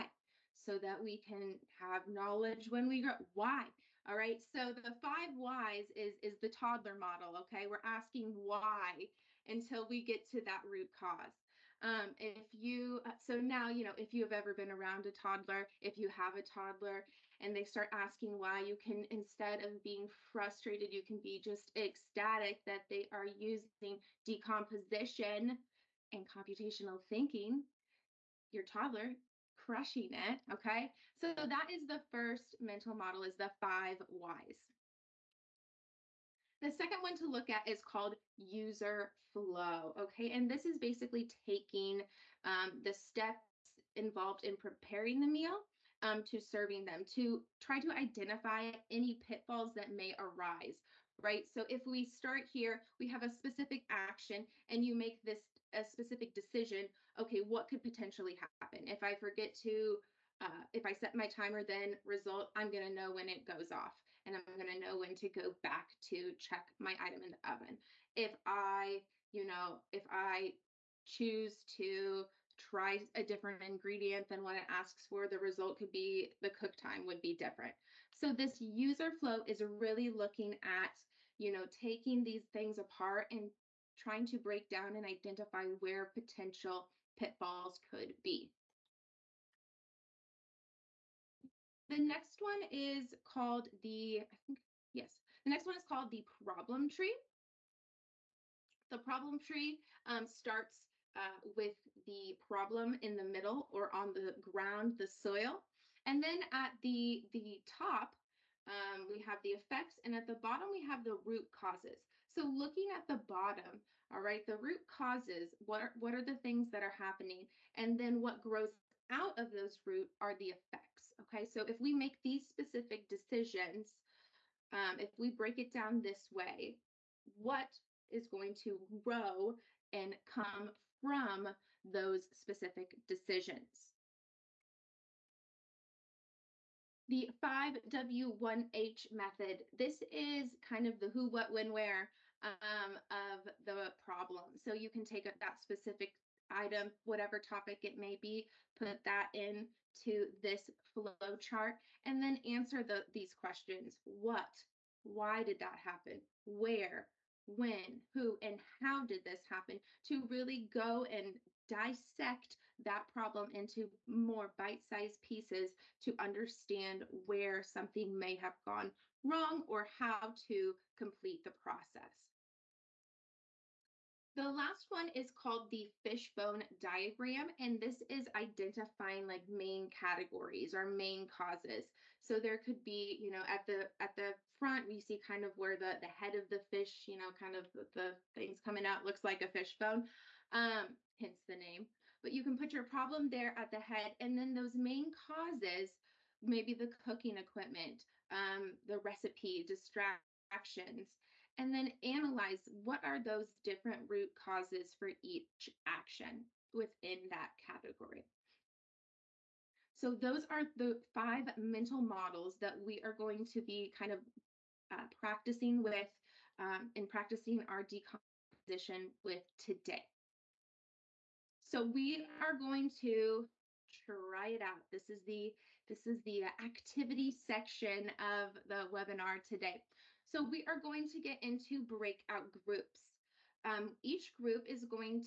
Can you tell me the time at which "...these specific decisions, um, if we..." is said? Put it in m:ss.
2:02.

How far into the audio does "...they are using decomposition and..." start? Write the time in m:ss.
0:22.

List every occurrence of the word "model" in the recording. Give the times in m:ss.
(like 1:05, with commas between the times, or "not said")
0:06, 0:32, 3:32.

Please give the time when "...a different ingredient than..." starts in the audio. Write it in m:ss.
1:13.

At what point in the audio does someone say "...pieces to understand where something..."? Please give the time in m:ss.
2:45.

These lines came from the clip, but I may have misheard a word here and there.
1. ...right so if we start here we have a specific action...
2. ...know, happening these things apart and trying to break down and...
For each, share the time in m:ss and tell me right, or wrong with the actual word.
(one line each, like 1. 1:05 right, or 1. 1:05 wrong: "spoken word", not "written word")
1. 0:51 right
2. 1:21 wrong: "taking", not "happening".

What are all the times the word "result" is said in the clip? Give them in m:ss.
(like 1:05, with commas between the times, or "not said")
1:02, 1:15.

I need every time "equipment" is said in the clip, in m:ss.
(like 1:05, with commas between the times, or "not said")
3:17.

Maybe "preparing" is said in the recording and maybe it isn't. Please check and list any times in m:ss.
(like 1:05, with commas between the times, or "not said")
0:44.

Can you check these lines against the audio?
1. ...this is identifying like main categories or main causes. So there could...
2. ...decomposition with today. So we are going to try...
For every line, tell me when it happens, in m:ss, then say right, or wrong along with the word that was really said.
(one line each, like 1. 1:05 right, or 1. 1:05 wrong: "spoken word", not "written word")
1. 2:57 right
2. 3:37 right.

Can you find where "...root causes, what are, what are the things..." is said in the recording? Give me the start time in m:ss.
1:54.